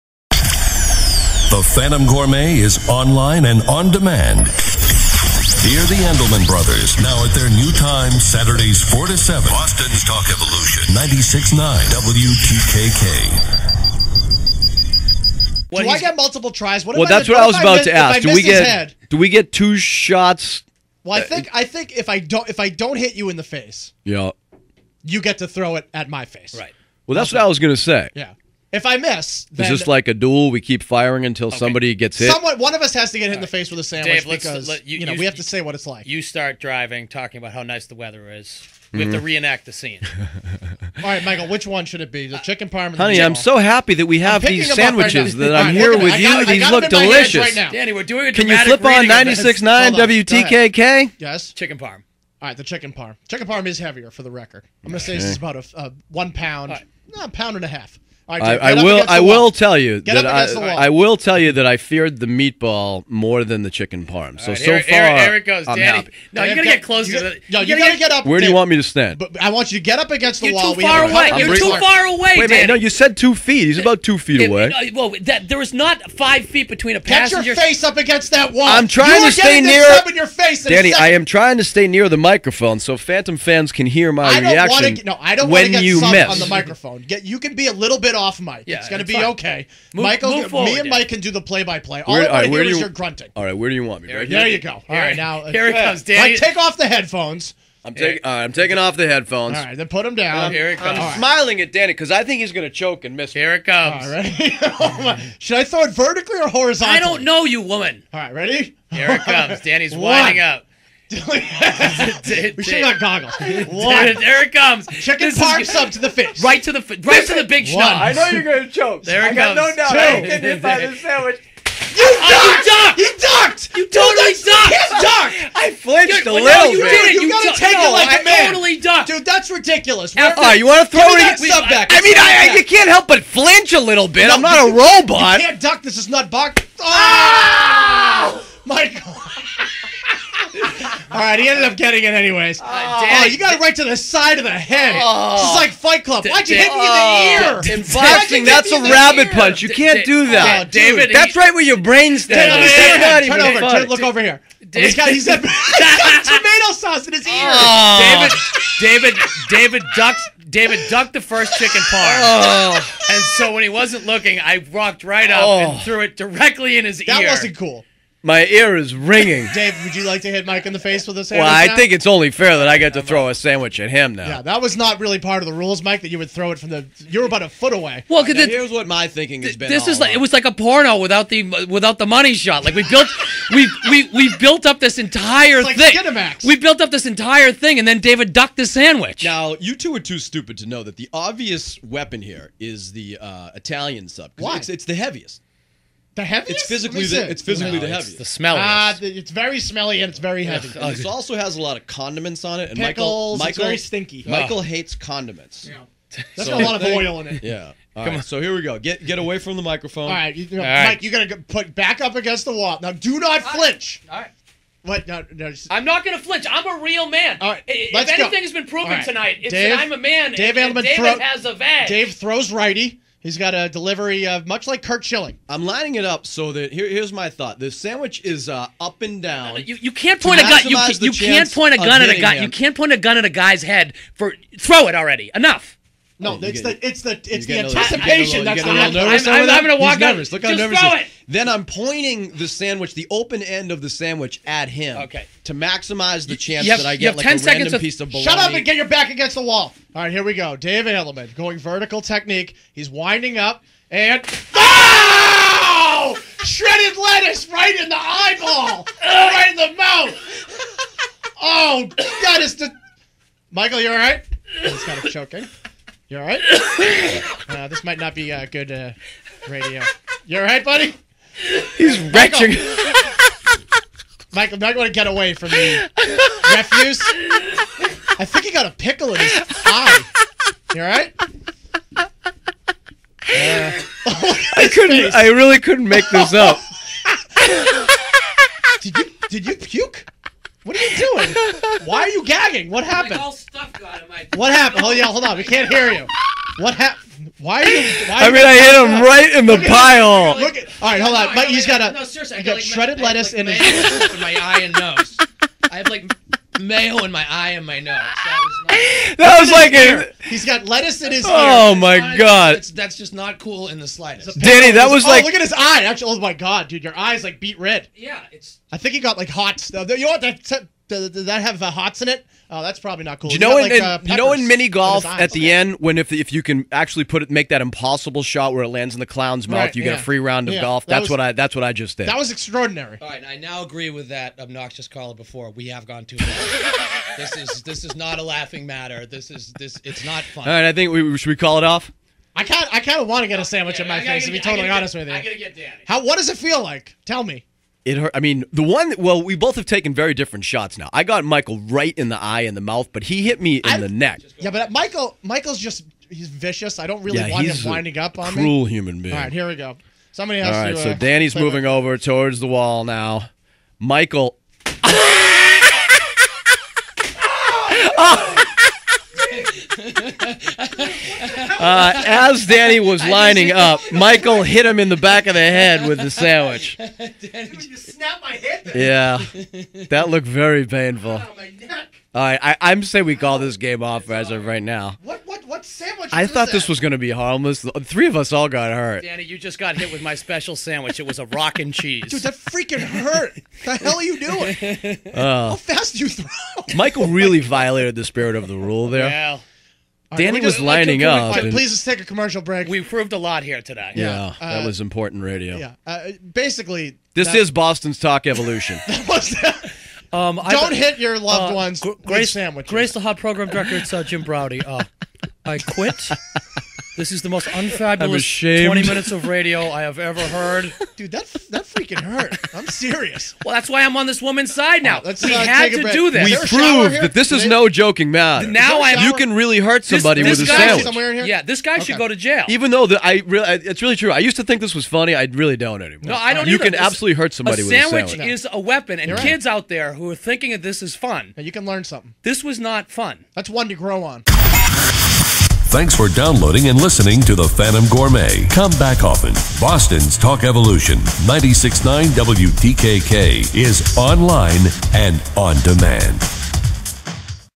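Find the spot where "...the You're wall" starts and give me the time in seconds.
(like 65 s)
70 s.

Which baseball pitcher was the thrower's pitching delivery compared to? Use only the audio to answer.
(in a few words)
Curt Schilling.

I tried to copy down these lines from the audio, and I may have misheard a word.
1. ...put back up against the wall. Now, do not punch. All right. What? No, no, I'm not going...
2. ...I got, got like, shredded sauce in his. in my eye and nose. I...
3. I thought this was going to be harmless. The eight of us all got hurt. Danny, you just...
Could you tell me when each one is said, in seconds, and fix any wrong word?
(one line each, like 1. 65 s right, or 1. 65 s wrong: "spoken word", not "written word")
1. 211 s wrong: "flinch", not "punch"
2. 302 s wrong: "lettuce", not "sauce"
3. 386 s wrong: "three", not "eight".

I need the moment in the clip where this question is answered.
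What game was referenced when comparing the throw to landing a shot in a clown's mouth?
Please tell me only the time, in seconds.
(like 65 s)
324 s.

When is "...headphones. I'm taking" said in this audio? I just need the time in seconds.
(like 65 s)
96 s.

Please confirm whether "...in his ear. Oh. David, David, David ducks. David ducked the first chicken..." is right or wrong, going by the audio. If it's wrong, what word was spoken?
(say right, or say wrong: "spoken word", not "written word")
right.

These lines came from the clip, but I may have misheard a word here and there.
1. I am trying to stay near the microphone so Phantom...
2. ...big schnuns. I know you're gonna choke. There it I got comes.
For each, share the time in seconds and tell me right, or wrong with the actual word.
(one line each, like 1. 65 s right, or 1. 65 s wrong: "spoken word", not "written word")
1. 80 s right
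2. 117 s right.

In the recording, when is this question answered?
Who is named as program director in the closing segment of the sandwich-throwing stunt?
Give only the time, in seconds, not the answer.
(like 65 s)
414 s.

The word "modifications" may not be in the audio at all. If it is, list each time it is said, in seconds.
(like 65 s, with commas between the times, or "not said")
not said.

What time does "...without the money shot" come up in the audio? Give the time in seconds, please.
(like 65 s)
181 s.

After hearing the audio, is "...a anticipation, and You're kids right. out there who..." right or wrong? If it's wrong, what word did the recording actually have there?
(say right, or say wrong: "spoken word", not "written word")
wrong: "weapon", not "anticipation".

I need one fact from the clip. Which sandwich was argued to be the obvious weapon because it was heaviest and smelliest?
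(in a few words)
Italian sub.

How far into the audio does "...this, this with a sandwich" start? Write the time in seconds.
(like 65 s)
430 s.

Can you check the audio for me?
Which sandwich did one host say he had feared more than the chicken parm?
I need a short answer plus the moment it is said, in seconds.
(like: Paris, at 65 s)
the meatball, at 62 s.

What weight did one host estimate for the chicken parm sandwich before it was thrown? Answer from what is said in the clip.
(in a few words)
a pound and a half.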